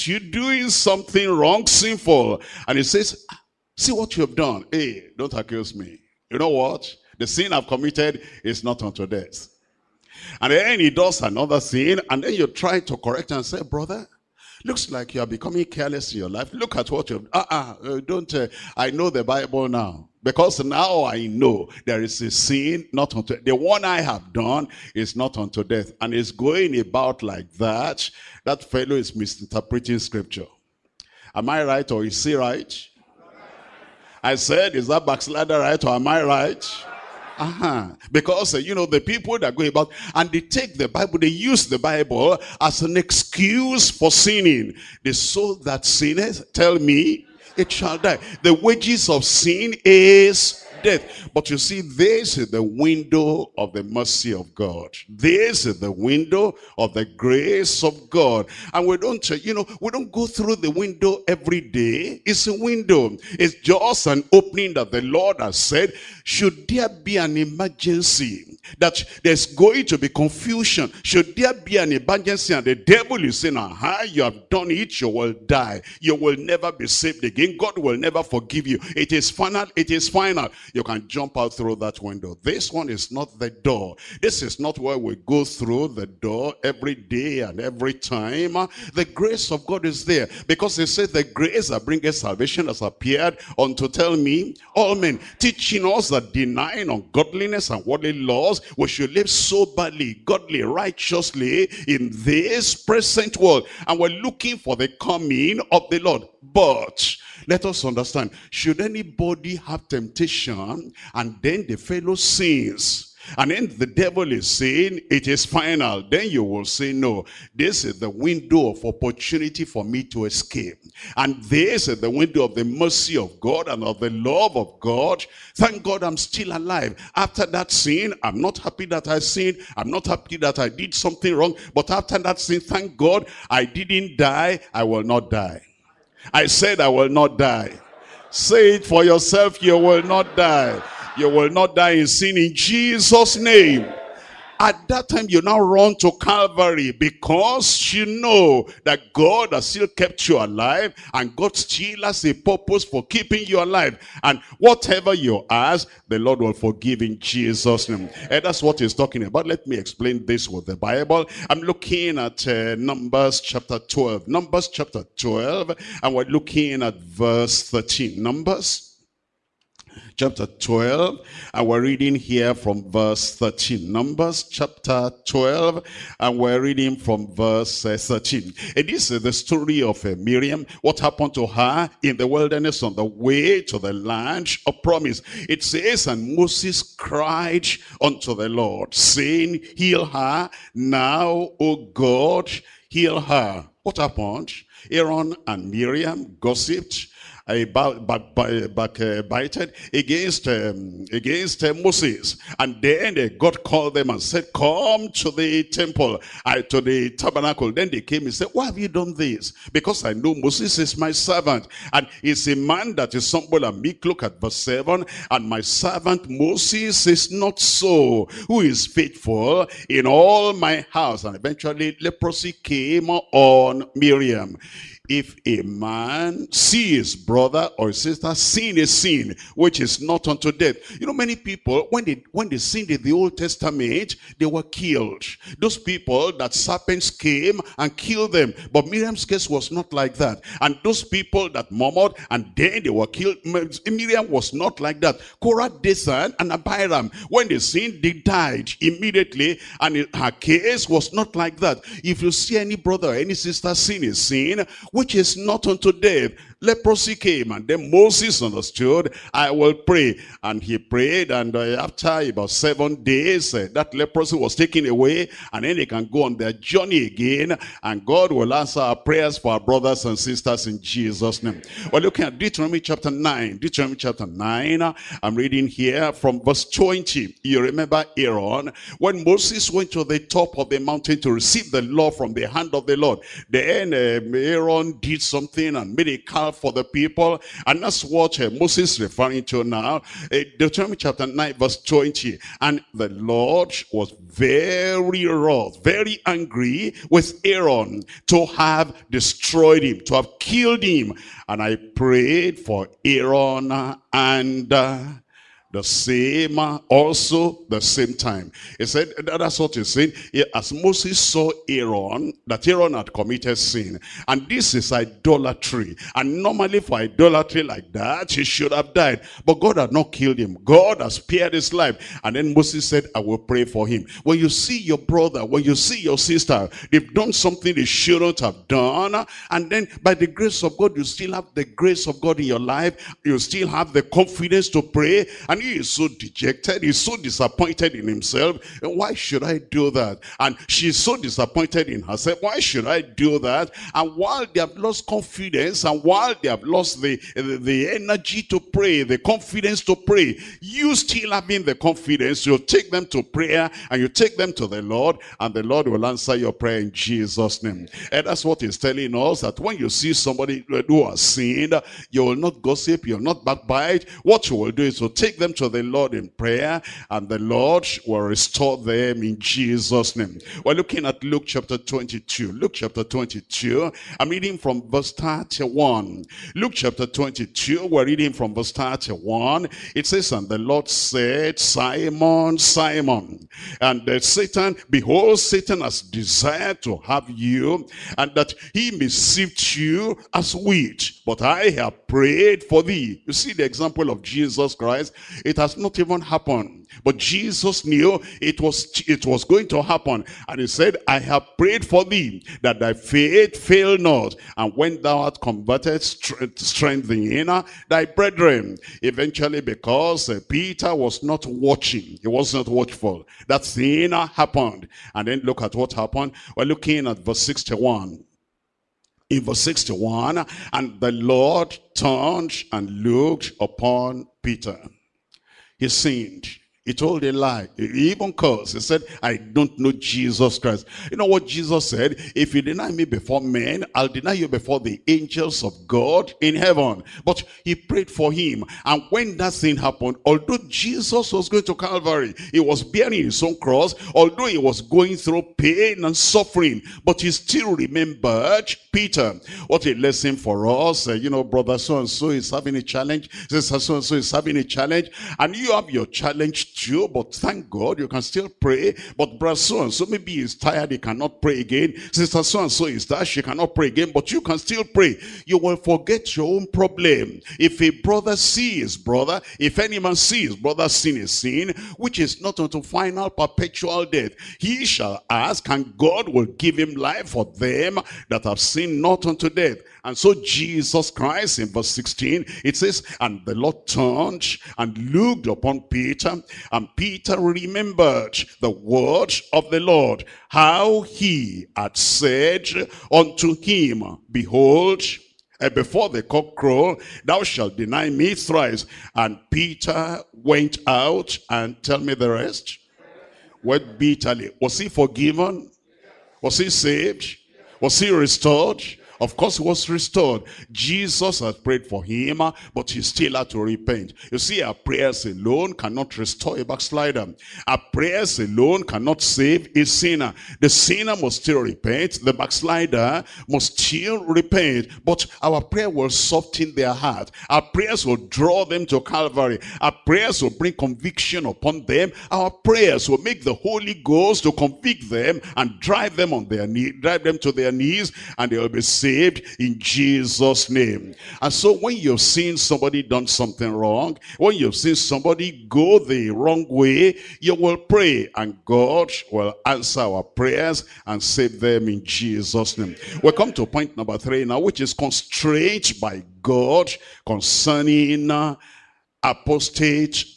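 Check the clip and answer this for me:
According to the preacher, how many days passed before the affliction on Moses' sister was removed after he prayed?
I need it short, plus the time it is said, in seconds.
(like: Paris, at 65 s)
7, at 262 s.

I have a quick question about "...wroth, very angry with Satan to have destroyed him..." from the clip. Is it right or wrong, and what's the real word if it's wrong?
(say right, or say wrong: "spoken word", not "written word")
wrong: "Aaron", not "Satan".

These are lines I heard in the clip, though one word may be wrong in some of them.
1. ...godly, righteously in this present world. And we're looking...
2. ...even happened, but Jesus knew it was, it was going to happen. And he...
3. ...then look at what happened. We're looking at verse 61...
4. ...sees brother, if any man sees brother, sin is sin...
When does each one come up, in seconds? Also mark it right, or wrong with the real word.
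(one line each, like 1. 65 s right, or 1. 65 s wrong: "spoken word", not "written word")
1. 100 s right
2. 395 s right
3. 415 s right
4. 468 s right.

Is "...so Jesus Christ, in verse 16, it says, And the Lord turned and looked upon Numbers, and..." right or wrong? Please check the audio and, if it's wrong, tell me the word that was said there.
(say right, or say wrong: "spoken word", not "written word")
wrong: "Peter", not "Numbers".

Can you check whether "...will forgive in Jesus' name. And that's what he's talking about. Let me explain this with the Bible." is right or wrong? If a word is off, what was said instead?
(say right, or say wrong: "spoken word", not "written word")
right.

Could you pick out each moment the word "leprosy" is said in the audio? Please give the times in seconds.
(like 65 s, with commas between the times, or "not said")
221 s, 256 s, 263 s.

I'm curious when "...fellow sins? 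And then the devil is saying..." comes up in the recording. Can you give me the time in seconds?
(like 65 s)
111 s.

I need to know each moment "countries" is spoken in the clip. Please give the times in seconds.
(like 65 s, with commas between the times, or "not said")
not said.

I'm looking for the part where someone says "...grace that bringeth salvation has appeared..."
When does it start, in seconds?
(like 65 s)
91 s.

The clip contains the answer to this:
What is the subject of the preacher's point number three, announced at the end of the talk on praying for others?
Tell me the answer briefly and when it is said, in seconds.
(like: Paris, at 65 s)
Apostate, at 559 s.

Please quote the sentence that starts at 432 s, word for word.
If you deny me before men, I'll deny you before the angels of God in heaven.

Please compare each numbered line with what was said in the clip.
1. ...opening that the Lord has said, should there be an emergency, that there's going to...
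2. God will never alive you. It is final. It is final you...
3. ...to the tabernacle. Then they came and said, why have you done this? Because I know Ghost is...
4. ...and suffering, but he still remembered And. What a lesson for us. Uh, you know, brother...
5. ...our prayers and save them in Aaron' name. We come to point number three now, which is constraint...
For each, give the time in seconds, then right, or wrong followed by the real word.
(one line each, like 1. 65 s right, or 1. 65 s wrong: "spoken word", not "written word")
1. 64 s right
2. 77 s wrong: "forgive", not "alive"
3. 206 s wrong: "Moses", not "Ghost"
4. 446 s wrong: "Peter", not "And"
5. 550 s wrong: "Jesus", not "Aaron".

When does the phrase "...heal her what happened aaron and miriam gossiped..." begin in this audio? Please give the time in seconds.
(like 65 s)
192 s.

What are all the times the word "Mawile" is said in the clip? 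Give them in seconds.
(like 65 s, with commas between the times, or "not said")
not said.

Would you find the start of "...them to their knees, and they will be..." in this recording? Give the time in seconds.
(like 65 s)
537 s.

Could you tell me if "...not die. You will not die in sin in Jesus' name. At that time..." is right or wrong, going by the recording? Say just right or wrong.
right.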